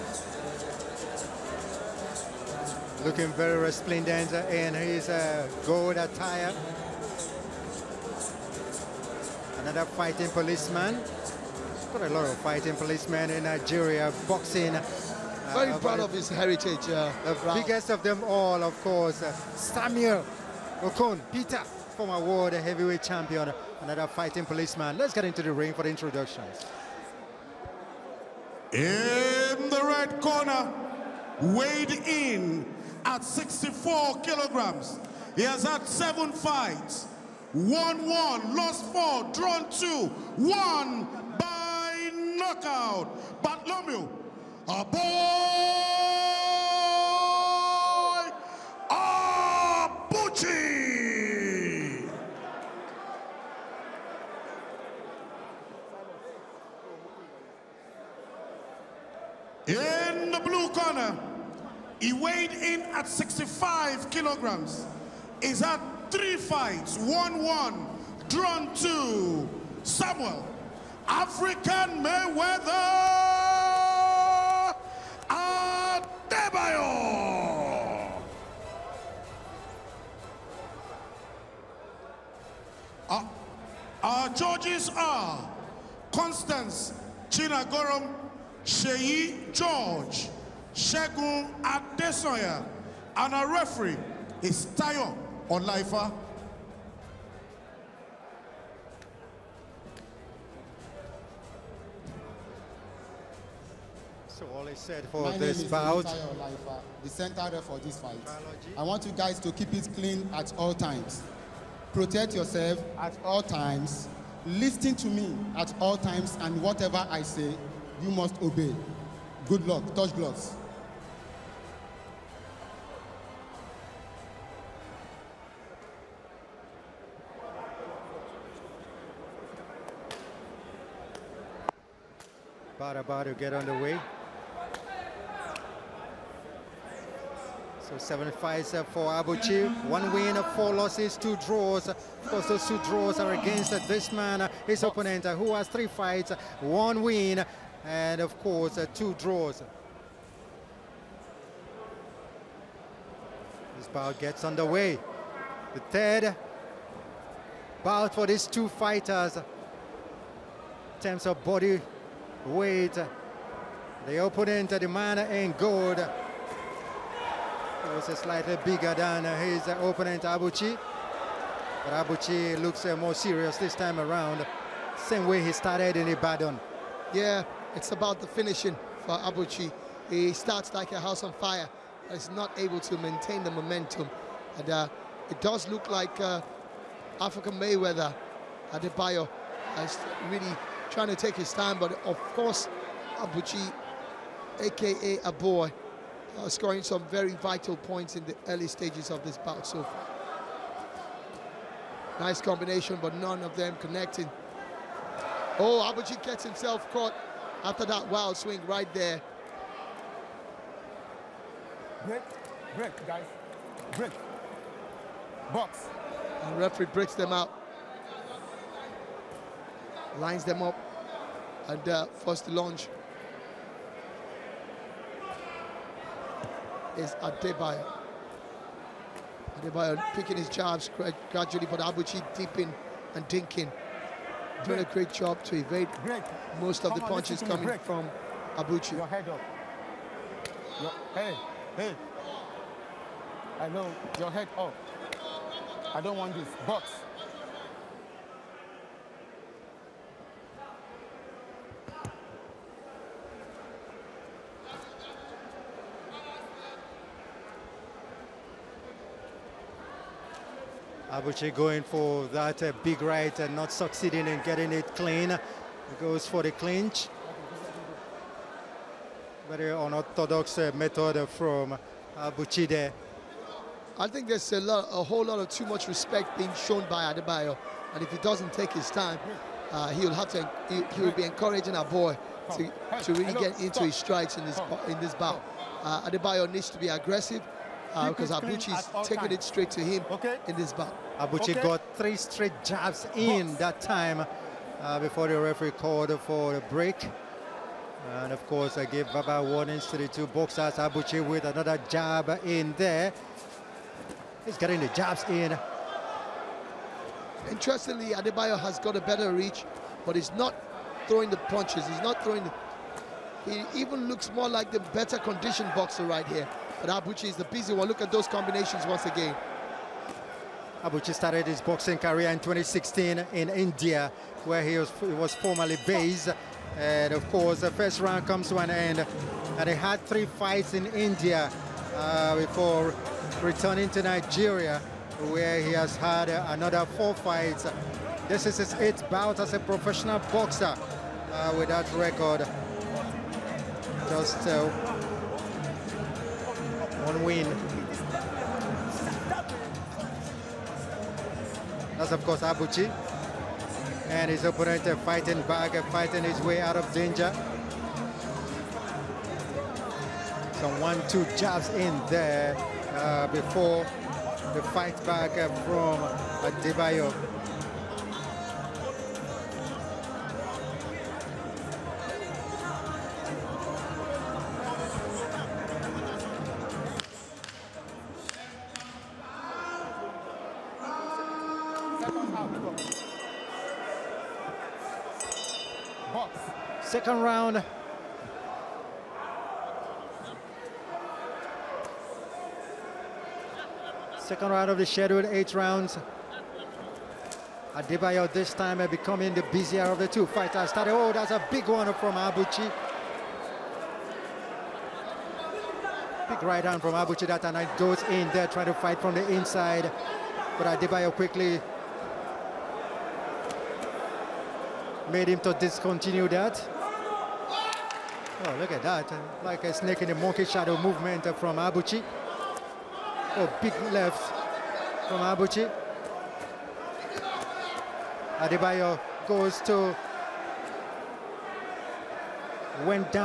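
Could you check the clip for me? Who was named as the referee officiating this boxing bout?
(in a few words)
Tayo Olaifa.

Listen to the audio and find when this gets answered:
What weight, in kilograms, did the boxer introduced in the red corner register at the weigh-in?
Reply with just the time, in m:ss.
0:33.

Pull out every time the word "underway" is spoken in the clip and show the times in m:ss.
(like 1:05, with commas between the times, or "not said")
2:13, 2:34.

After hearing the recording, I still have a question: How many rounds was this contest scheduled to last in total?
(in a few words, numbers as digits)
8.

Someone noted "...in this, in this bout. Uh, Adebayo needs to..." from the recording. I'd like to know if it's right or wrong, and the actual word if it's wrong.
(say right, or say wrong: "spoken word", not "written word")
right.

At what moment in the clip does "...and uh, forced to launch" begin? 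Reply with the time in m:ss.
3:41.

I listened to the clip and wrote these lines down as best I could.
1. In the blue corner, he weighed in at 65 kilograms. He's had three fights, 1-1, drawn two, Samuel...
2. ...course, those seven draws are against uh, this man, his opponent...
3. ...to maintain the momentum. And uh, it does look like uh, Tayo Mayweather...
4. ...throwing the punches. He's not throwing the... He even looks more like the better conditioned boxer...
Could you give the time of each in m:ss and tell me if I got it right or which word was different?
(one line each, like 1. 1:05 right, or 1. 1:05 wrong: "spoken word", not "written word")
1. 0:59 right
2. 2:22 wrong: "two", not "seven"
3. 3:02 wrong: "African", not "Tayo"
4. 5:11 right.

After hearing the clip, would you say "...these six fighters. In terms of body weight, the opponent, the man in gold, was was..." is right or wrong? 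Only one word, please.
wrong.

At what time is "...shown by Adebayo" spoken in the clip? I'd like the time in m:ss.
4:36.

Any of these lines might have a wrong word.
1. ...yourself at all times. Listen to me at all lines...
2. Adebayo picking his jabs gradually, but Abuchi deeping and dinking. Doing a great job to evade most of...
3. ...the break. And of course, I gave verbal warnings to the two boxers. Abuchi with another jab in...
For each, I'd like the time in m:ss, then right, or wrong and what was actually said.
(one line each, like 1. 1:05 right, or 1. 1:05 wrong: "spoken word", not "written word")
1. 1:52 wrong: "times", not "lines"
2. 3:49 right
3. 4:56 right.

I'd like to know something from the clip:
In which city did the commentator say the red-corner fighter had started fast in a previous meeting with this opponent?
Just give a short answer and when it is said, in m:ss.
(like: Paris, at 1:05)
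Ibadan, at 2:56.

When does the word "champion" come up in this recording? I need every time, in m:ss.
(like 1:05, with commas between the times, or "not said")
0:23.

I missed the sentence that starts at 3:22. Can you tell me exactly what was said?
Nice combination, but none of them connecting.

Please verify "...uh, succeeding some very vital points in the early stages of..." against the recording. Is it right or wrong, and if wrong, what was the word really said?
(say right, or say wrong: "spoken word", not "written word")
wrong: "scoring", not "succeeding".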